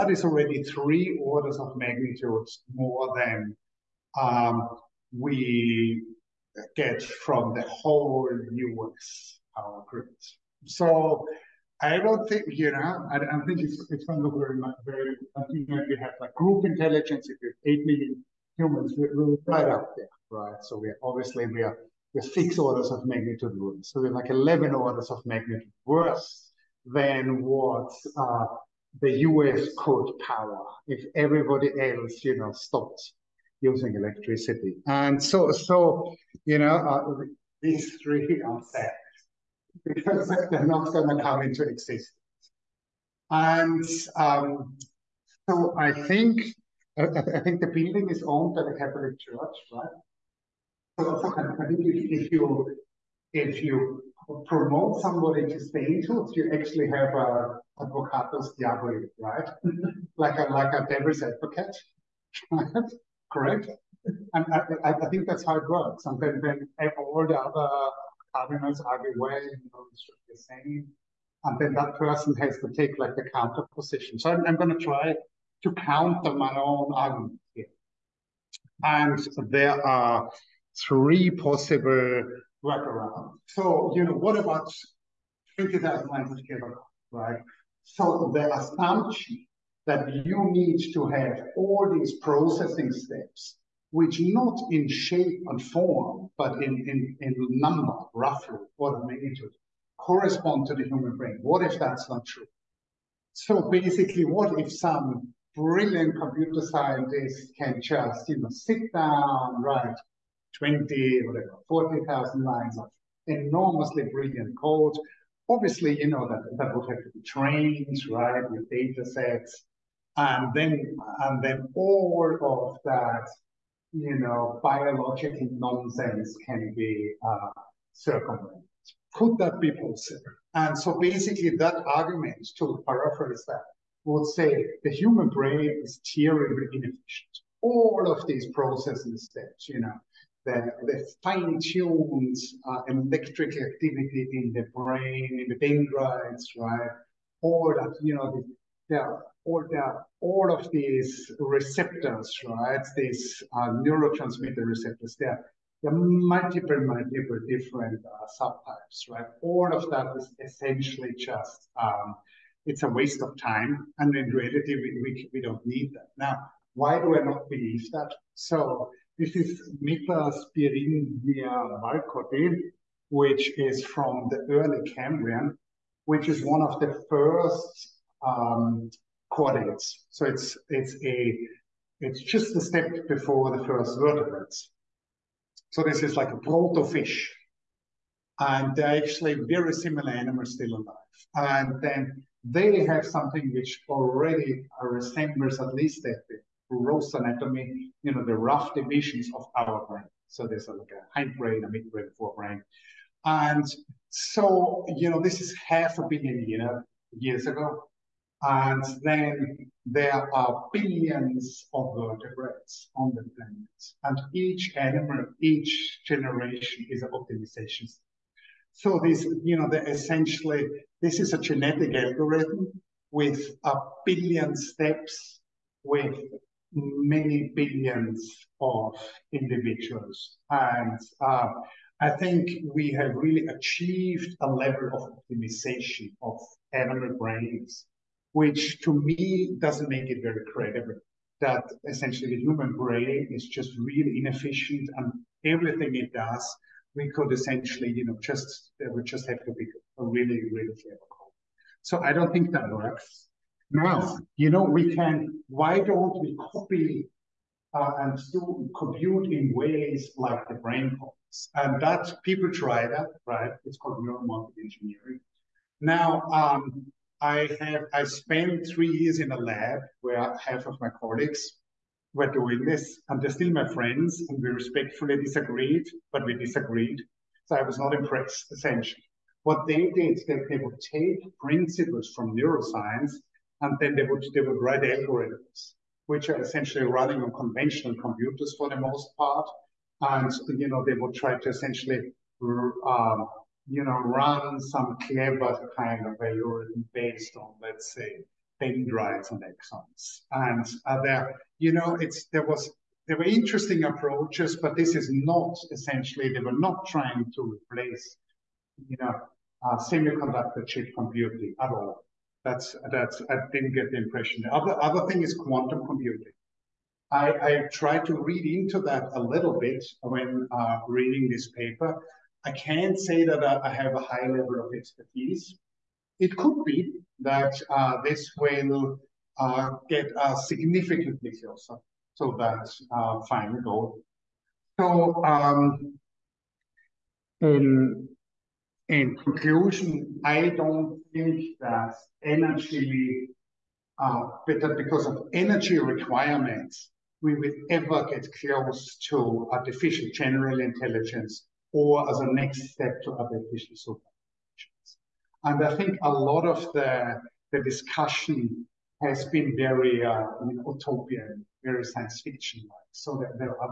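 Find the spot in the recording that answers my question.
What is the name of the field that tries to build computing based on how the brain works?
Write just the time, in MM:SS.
04:24.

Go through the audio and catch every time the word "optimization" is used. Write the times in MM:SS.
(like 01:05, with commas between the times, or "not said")
03:37, 03:55.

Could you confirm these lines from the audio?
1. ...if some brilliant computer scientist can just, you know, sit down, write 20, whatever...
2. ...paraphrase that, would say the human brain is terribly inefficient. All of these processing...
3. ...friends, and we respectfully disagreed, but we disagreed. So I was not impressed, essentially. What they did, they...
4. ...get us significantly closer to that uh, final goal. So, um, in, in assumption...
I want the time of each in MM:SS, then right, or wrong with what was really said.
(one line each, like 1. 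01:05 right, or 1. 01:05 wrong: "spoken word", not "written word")
1. 01:44 right
2. 02:12 right
3. 04:33 right
4. 05:29 wrong: "conclusion", not "assumption".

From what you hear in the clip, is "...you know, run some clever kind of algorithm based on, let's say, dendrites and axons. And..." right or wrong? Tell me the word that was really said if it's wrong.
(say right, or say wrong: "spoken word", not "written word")
right.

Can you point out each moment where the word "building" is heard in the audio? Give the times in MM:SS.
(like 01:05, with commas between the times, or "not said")
00:47.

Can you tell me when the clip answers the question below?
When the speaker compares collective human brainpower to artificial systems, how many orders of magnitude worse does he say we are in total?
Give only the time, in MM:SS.
00:24.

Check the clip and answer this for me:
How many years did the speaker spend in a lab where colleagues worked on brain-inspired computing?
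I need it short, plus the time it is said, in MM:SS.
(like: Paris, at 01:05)
3, at 04:28.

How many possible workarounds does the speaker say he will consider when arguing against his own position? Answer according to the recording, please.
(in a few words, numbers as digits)
3.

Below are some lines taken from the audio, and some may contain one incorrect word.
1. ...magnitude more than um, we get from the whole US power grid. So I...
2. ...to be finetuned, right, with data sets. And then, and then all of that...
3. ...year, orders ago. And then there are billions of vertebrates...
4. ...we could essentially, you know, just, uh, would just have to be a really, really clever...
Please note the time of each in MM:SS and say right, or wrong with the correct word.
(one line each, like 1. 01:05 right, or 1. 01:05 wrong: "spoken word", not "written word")
1. 00:01 right
2. 01:57 wrong: "trained", not "finetuned"
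3. 03:26 wrong: "years", not "orders"
4. 04:06 right.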